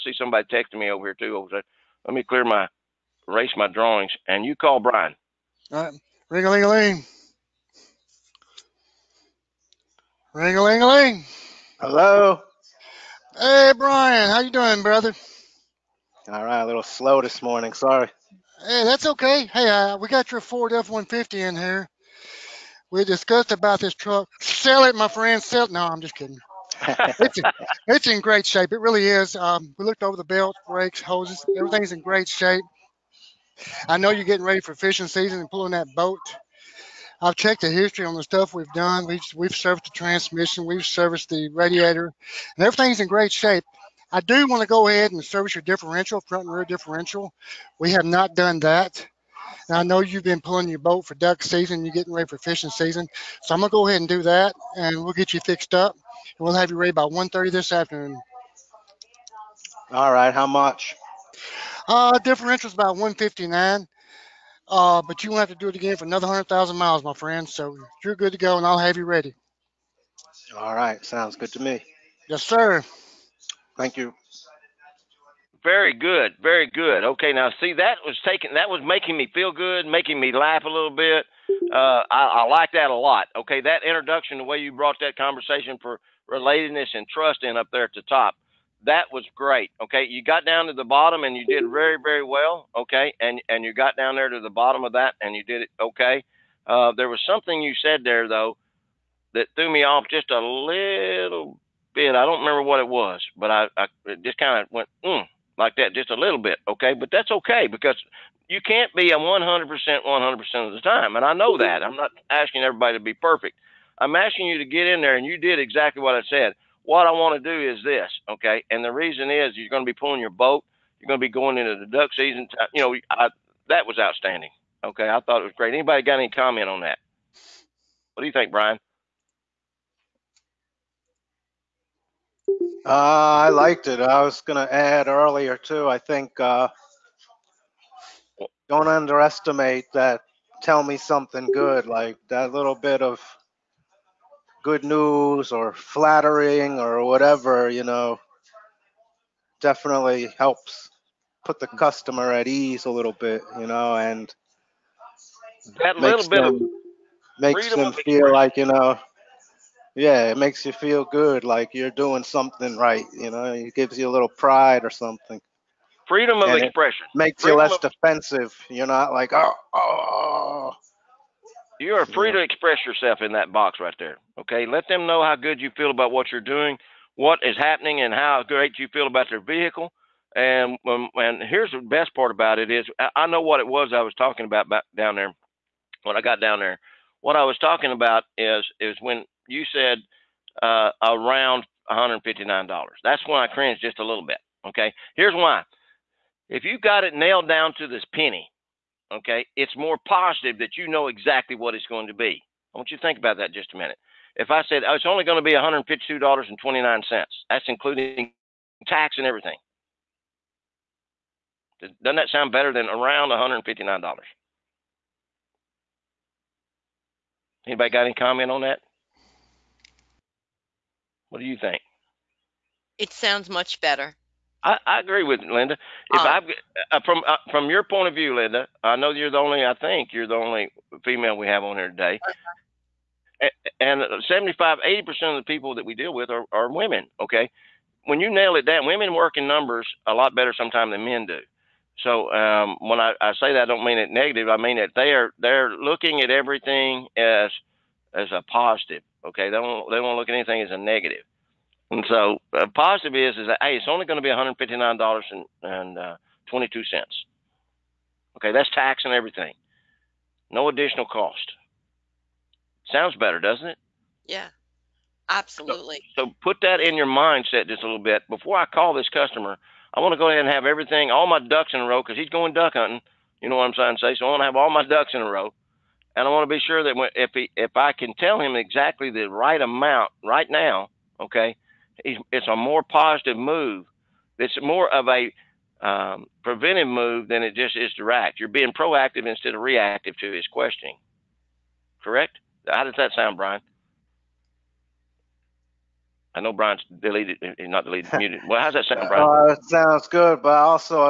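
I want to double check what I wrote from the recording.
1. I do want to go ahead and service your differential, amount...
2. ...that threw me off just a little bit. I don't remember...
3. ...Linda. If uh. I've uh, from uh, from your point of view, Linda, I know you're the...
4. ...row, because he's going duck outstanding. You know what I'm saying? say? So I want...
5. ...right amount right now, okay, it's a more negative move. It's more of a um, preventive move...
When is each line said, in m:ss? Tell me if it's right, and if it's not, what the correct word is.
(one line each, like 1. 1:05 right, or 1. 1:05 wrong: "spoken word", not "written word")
1. 0:44 wrong: "front", not "amount"
2. 1:39 right
3. 3:45 right
4. 4:31 wrong: "hunting", not "outstanding"
5. 4:39 wrong: "positive", not "negative".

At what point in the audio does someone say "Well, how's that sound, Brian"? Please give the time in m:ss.
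4:58.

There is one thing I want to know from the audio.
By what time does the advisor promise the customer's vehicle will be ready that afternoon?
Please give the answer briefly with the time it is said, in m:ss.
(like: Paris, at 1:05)
1:30, at 0:57.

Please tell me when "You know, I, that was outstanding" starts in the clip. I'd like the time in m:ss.
2:02.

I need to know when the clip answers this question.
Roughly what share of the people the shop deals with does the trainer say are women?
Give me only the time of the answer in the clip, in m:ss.
3:54.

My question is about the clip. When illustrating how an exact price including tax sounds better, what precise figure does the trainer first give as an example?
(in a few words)
$152.29.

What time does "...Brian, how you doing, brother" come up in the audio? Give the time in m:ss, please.
0:13.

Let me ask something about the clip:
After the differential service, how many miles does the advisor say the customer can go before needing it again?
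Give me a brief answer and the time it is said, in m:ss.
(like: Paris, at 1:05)
100,000 miles, at 1:06.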